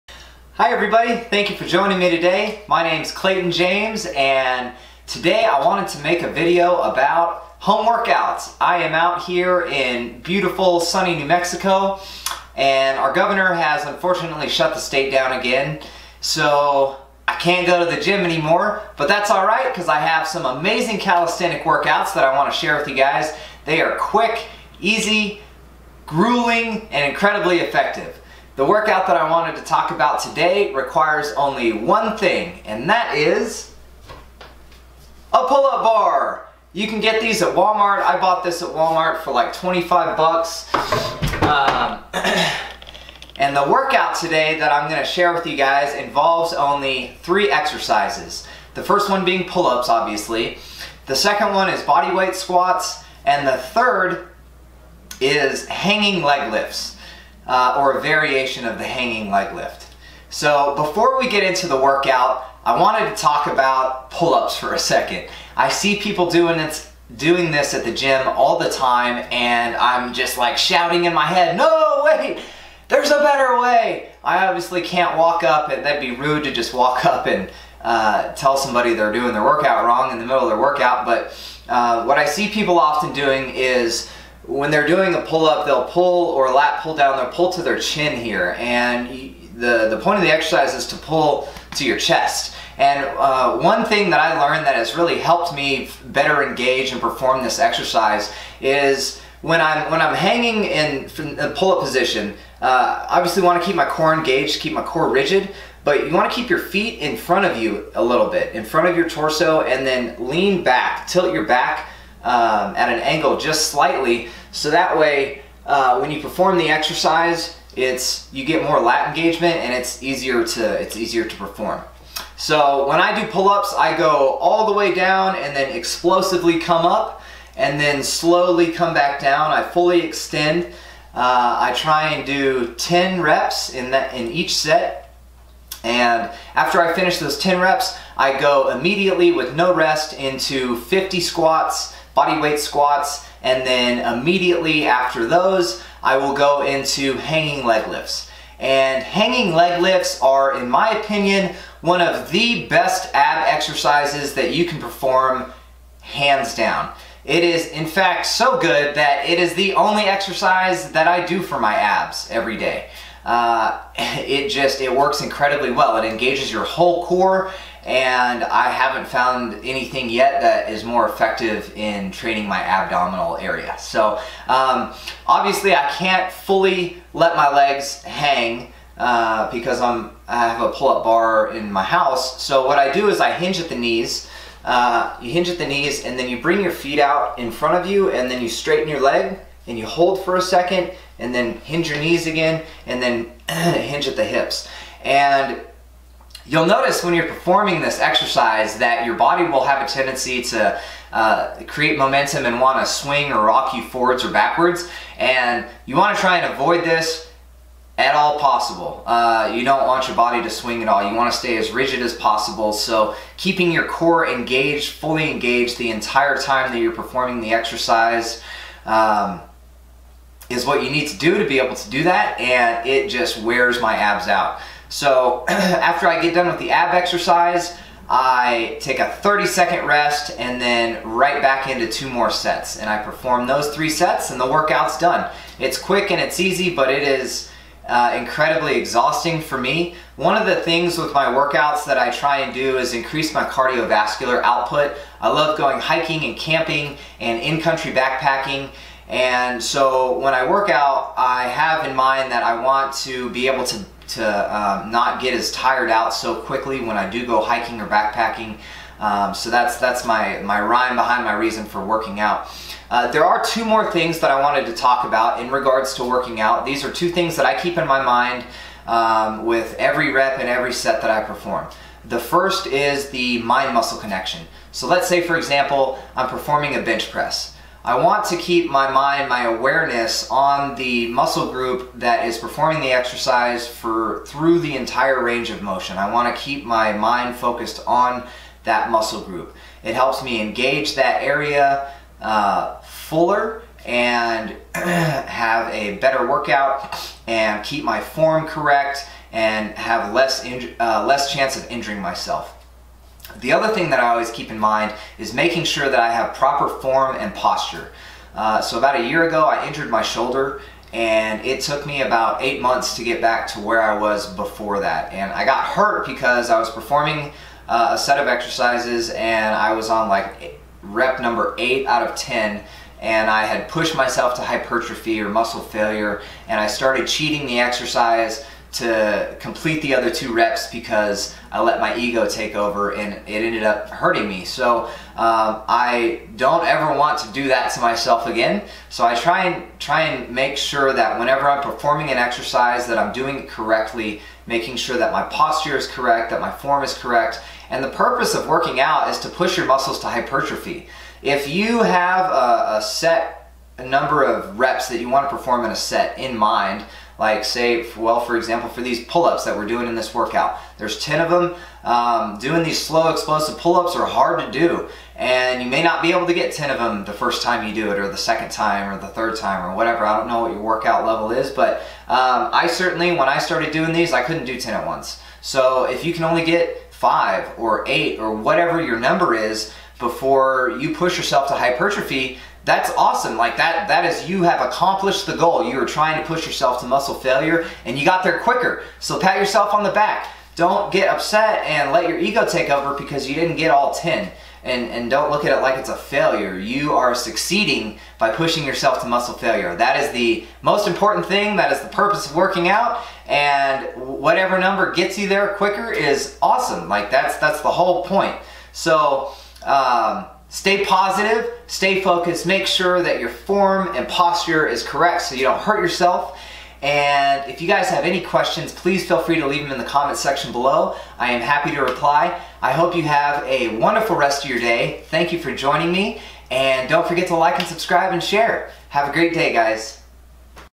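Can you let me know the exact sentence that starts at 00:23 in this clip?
They are quick, easy, grueling, and incredibly effective.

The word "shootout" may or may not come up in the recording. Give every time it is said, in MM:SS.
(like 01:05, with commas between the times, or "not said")
not said.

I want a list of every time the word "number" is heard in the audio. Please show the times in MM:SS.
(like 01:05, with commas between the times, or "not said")
05:21, 05:53, 06:18, 06:44.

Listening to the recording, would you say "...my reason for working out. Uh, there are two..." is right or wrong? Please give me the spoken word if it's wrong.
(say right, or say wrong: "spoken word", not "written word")
right.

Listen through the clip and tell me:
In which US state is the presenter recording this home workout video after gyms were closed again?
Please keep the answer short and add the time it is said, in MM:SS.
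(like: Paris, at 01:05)
New Mexico, at 00:11.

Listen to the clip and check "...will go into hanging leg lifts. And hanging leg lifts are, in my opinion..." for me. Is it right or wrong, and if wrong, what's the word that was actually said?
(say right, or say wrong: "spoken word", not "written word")
right.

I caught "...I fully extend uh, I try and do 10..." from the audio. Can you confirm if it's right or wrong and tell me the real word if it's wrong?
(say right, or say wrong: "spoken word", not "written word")
right.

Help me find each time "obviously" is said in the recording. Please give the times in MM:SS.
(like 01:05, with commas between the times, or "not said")
00:49, 01:14, 01:43, 02:55.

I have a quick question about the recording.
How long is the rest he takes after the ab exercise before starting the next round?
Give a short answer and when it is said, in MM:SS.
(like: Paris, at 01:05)
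30 seconds, at 03:49.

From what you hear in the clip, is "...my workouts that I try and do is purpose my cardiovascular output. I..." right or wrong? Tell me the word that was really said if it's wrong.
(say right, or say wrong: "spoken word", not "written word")
wrong: "increase", not "purpose".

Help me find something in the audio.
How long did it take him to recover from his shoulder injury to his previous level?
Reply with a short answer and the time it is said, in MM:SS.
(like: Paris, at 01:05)
eight months, at 05:12.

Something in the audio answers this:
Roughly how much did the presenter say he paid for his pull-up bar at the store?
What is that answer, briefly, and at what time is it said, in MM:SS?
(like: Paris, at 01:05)
25 bucks, at 00:39.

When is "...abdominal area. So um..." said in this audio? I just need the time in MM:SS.
02:52.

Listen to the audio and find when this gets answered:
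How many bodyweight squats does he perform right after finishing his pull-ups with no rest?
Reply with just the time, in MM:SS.
02:20.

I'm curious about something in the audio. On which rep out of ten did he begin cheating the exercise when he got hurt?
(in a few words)
8.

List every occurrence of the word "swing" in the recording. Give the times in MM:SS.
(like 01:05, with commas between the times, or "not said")
03:22, 03:30.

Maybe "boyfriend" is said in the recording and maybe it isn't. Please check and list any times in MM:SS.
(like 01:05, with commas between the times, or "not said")
not said.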